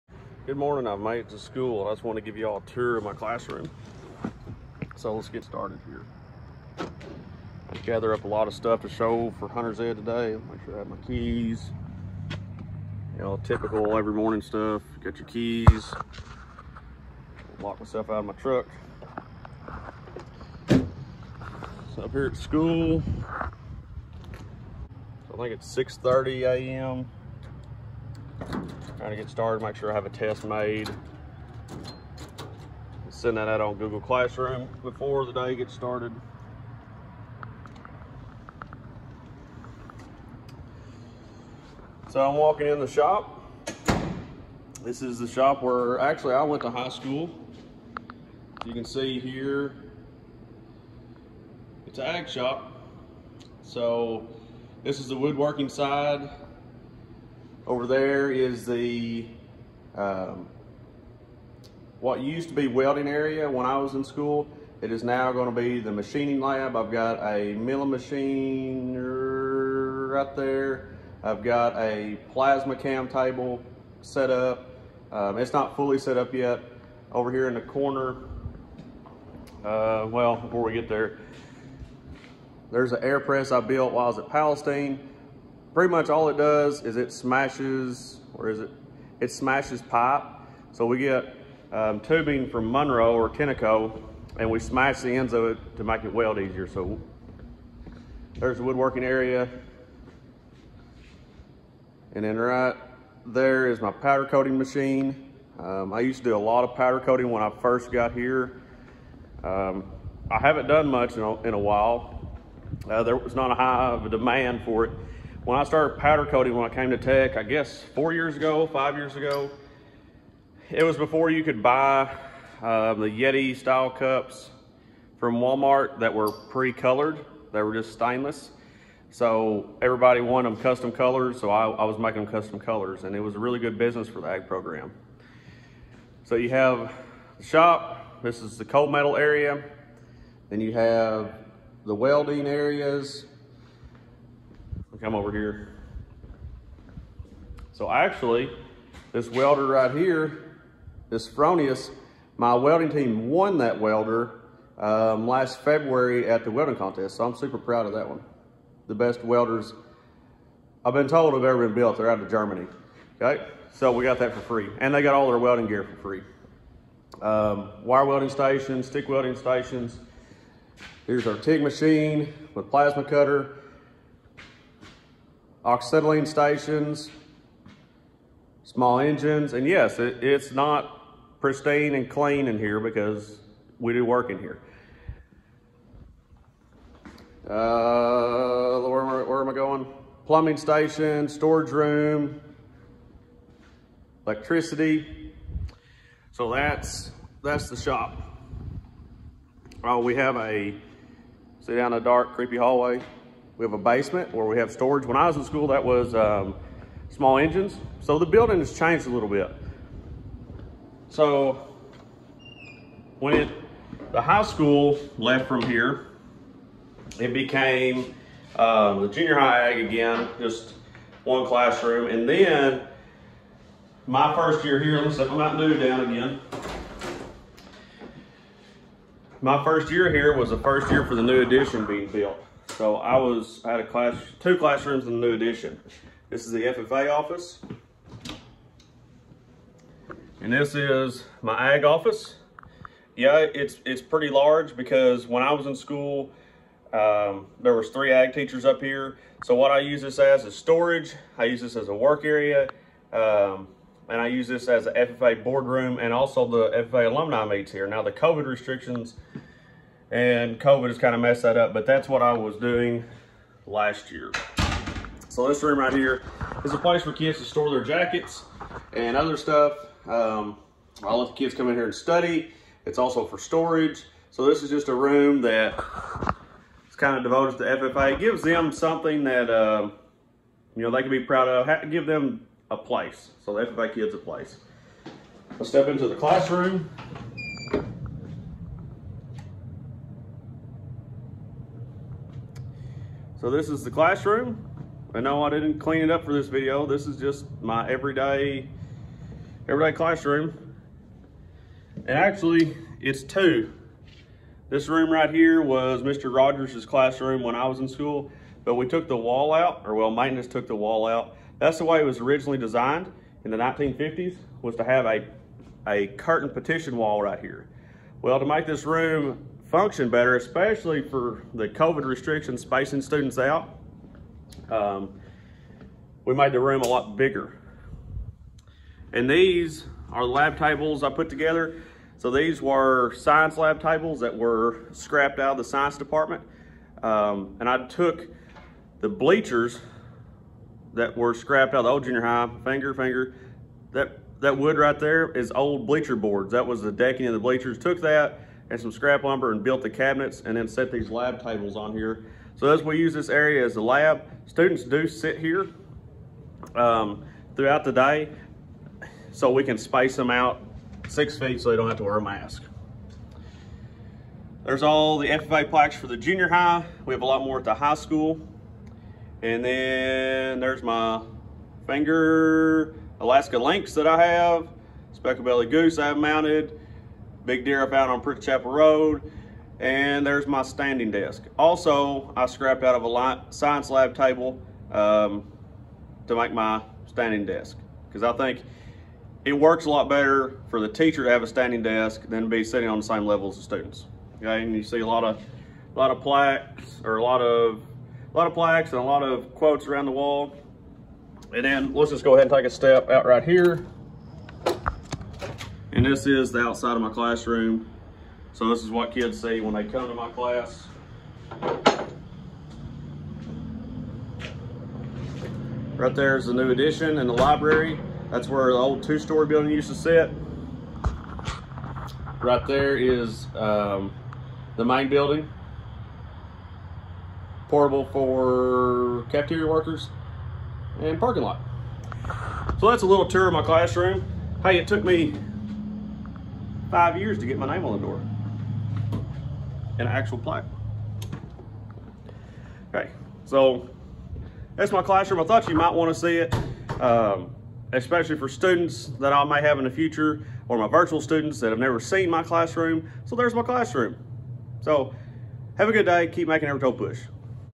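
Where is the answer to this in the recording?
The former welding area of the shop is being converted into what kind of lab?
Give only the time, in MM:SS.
01:05.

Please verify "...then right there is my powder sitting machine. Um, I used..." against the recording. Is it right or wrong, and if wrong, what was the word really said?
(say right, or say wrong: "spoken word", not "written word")
wrong: "coating", not "sitting".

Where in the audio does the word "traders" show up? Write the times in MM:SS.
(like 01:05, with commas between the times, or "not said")
not said.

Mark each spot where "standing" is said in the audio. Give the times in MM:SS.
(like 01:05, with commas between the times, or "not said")
06:20, 06:27, 06:31.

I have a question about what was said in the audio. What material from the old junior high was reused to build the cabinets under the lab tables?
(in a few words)
bleacher boards.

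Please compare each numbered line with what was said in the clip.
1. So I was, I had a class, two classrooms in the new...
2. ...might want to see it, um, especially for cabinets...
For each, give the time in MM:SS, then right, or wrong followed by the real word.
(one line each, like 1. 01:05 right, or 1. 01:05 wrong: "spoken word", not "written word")
1. 03:52 right
2. 07:25 wrong: "students", not "cabinets".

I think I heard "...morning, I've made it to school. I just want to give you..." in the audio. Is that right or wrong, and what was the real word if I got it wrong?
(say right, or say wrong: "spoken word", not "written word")
right.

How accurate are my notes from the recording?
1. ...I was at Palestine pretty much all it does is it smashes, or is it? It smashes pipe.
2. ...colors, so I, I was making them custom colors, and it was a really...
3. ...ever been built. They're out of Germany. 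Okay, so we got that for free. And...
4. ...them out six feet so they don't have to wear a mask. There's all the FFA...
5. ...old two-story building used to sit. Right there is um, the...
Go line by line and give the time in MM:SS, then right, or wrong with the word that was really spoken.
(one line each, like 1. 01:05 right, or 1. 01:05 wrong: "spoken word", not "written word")
1. 01:24 right
2. 02:10 right
3. 02:41 right
4. 06:00 right
5. 06:58 right.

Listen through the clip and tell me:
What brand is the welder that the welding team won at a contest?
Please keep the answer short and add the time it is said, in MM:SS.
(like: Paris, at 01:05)
Fronius, at 02:31.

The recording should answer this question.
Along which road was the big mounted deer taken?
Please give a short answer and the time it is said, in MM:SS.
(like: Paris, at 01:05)
Prince Chapel Road, at 06:18.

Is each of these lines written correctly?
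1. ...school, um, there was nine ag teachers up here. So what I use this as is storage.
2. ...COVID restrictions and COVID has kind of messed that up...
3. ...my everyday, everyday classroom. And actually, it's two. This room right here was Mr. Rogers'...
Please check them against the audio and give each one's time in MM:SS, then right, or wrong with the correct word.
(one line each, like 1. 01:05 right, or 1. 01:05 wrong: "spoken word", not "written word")
1. 04:05 wrong: "three", not "nine"
2. 04:18 right
3. 04:57 right.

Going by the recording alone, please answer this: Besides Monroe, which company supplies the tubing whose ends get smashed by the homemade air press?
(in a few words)
Tenneco.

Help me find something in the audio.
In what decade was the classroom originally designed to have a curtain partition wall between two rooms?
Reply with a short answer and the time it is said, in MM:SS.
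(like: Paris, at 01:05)
1950s, at 05:13.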